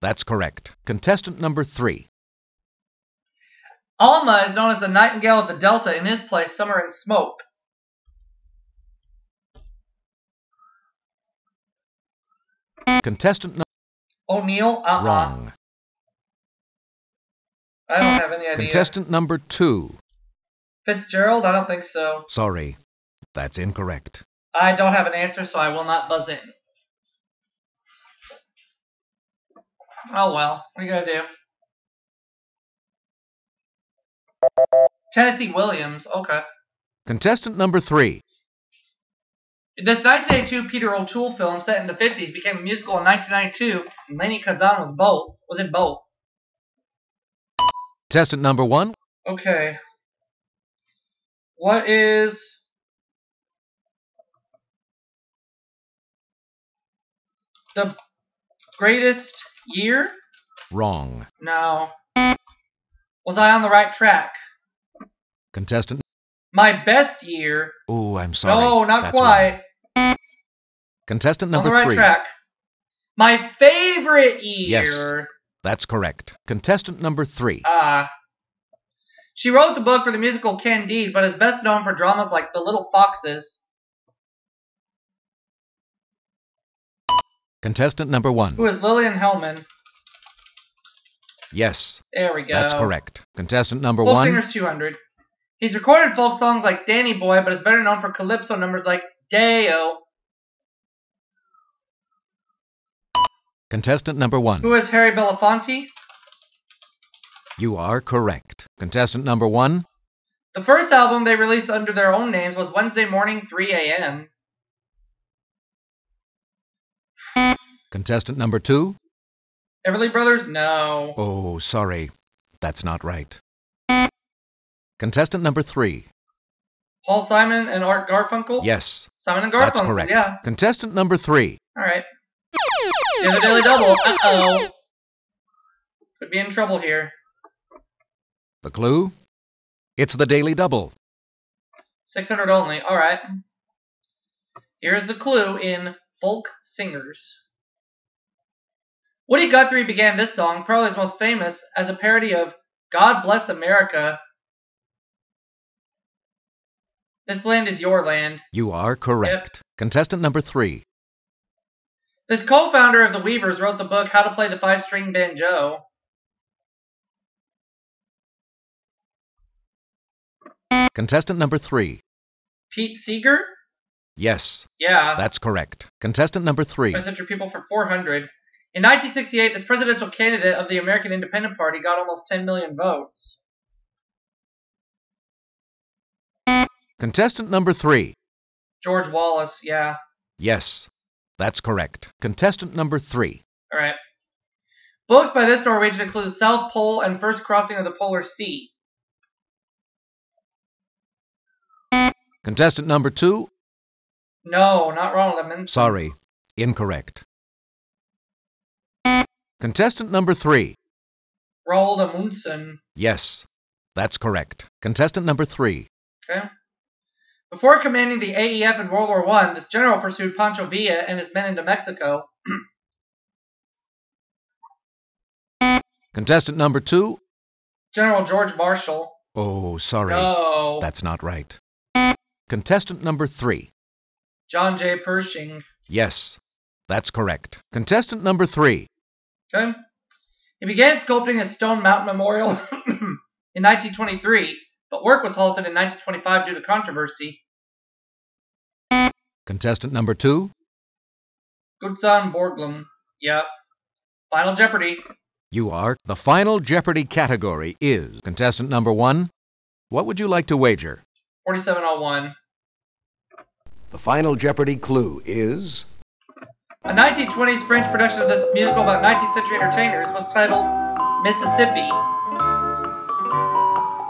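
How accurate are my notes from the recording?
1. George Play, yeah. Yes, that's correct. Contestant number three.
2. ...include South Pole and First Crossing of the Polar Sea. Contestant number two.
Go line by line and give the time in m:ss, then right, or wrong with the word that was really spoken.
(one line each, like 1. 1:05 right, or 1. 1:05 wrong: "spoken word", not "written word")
1. 3:08 wrong: "Wallace", not "Play"
2. 3:16 right.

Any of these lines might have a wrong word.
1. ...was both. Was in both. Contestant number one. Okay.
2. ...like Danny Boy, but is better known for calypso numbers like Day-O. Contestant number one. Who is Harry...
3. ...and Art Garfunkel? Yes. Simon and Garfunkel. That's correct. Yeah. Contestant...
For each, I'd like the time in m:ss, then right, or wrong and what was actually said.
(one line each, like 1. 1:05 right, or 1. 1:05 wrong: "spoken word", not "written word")
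1. 0:44 right
2. 1:36 right
3. 2:07 right.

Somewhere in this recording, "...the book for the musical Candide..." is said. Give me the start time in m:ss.
1:19.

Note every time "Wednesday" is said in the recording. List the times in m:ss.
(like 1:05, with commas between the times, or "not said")
1:52.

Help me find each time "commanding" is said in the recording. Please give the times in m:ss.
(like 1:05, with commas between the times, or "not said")
3:37.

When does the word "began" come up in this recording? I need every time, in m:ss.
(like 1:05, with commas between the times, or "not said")
2:29, 4:00.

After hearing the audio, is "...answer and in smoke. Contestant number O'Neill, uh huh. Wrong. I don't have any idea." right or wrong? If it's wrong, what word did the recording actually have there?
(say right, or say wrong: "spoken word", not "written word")
wrong: "summer", not "answer".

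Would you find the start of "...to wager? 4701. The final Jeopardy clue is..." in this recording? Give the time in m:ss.
4:20.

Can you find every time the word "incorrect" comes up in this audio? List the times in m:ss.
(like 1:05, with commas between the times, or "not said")
0:23, 3:26.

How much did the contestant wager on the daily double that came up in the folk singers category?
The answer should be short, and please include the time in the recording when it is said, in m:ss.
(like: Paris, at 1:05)
600, at 2:22.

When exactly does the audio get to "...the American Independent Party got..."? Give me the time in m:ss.
3:00.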